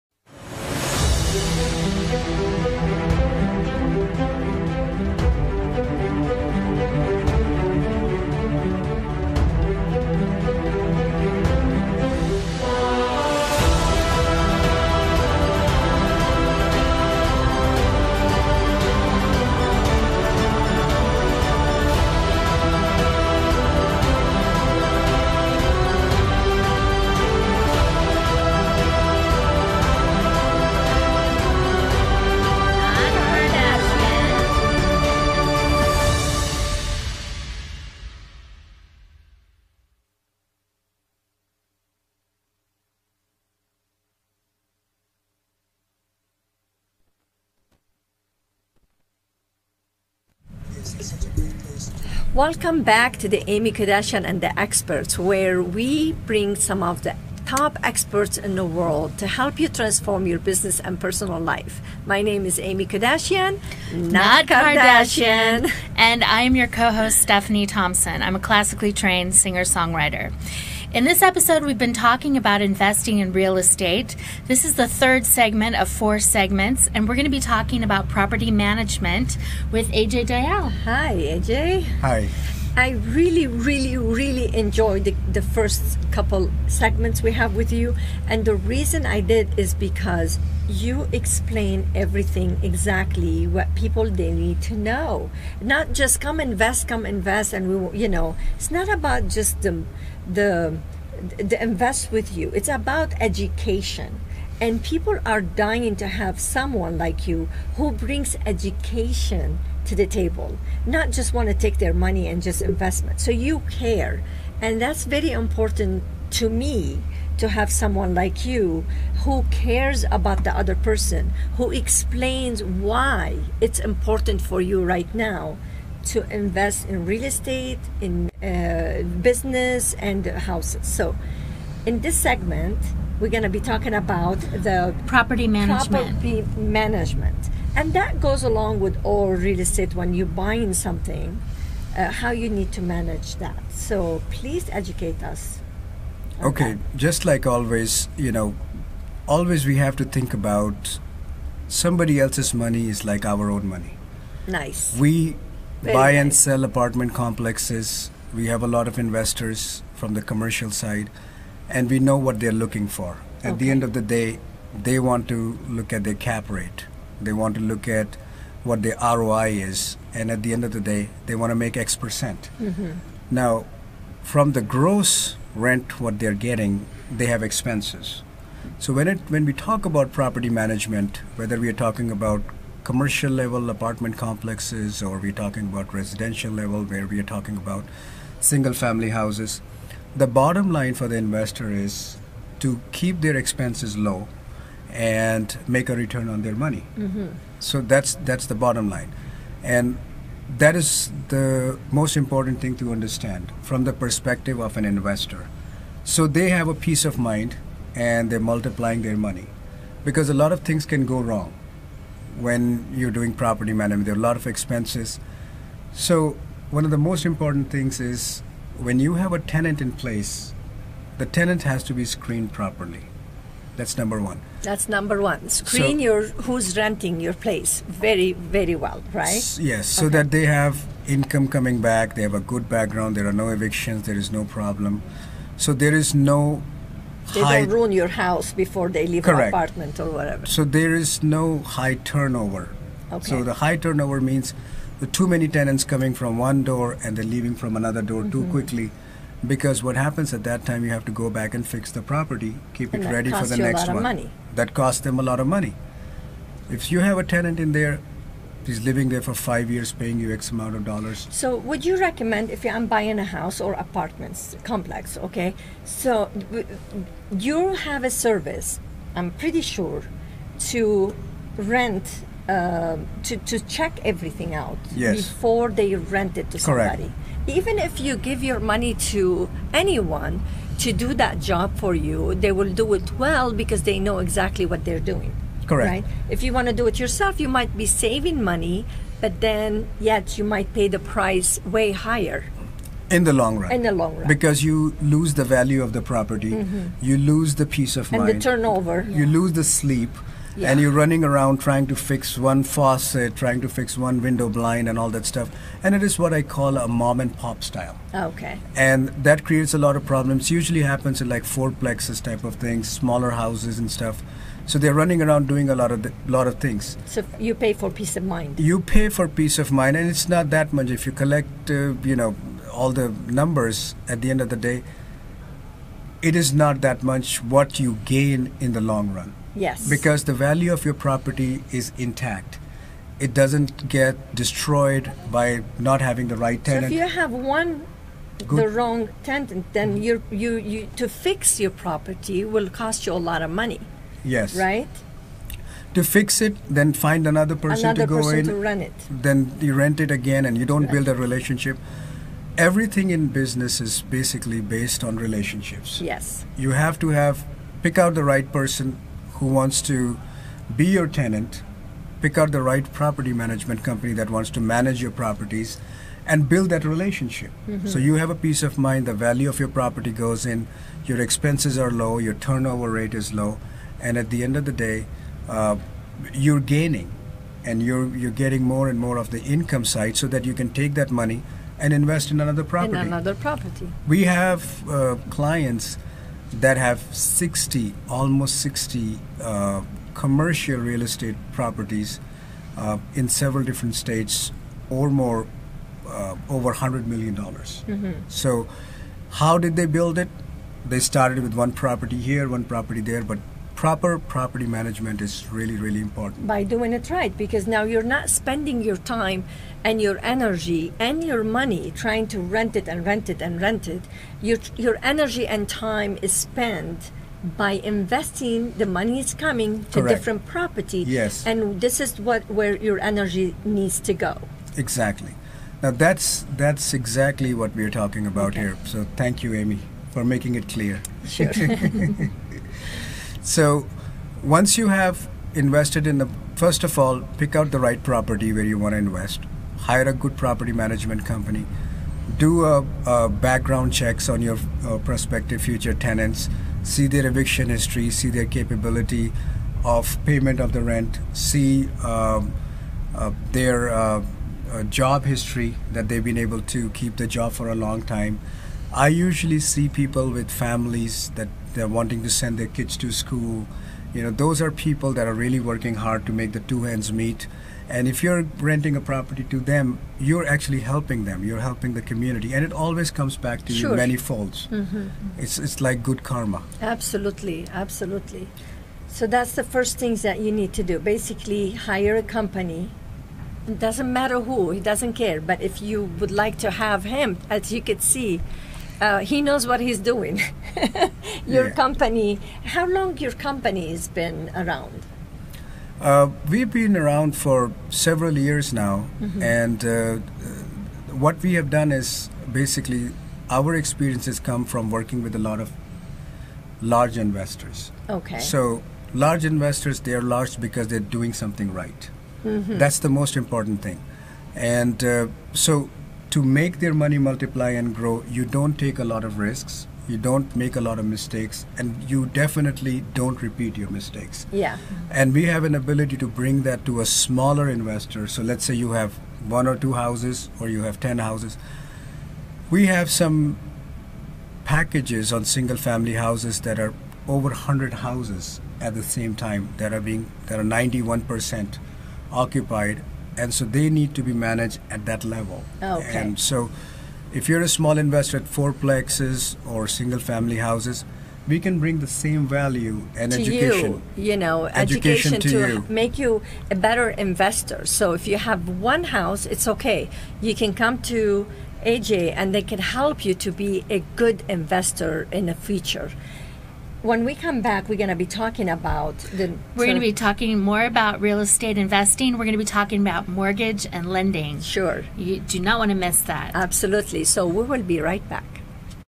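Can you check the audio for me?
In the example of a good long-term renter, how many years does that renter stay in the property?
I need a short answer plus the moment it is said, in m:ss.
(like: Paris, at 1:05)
5, at 4:19.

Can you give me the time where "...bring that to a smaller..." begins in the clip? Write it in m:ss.
8:46.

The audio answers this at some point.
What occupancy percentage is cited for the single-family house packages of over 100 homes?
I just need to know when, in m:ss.
9:00.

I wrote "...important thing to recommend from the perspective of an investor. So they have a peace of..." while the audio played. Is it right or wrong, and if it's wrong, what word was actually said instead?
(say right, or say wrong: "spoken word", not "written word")
wrong: "understand", not "recommend".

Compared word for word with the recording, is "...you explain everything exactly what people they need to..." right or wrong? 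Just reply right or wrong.
right.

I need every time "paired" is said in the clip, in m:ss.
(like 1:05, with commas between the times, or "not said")
not said.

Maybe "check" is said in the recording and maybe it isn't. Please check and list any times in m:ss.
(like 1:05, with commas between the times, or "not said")
4:33, 7:23.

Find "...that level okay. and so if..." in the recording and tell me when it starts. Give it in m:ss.
9:05.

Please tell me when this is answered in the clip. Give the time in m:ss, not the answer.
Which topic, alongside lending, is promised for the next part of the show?
9:33.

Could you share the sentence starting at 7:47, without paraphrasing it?
And if you're renting a property to them, you're actually helping them.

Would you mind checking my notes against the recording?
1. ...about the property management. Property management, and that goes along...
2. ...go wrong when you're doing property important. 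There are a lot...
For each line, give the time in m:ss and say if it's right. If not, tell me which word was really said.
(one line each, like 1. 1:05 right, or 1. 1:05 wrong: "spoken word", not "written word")
1. 2:13 right
2. 3:31 wrong: "management", not "important".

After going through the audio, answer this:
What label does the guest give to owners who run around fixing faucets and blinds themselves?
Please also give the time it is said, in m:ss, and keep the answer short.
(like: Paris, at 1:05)
mom and pop style, at 5:06.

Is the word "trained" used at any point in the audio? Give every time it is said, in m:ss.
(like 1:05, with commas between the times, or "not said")
1:08.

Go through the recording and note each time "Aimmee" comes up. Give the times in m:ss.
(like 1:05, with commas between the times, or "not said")
0:53, 1:02.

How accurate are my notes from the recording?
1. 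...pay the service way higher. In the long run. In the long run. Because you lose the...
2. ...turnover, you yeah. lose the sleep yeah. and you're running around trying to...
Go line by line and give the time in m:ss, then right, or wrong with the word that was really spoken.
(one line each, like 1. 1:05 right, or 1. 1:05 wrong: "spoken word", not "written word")
1. 4:50 wrong: "price", not "service"
2. 4:58 right.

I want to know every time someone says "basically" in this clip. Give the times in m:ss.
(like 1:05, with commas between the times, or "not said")
5:54, 8:00, 8:22.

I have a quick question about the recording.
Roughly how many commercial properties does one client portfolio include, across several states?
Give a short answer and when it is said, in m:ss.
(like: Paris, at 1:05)
almost 60, at 6:28.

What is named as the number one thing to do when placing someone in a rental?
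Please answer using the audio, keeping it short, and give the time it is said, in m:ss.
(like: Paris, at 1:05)
screened properly, at 3:42.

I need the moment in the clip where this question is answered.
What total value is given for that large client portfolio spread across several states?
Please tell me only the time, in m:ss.
6:36.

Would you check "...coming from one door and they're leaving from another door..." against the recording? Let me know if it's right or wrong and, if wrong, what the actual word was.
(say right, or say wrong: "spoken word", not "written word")
right.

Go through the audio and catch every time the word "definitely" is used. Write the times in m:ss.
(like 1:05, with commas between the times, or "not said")
8:42.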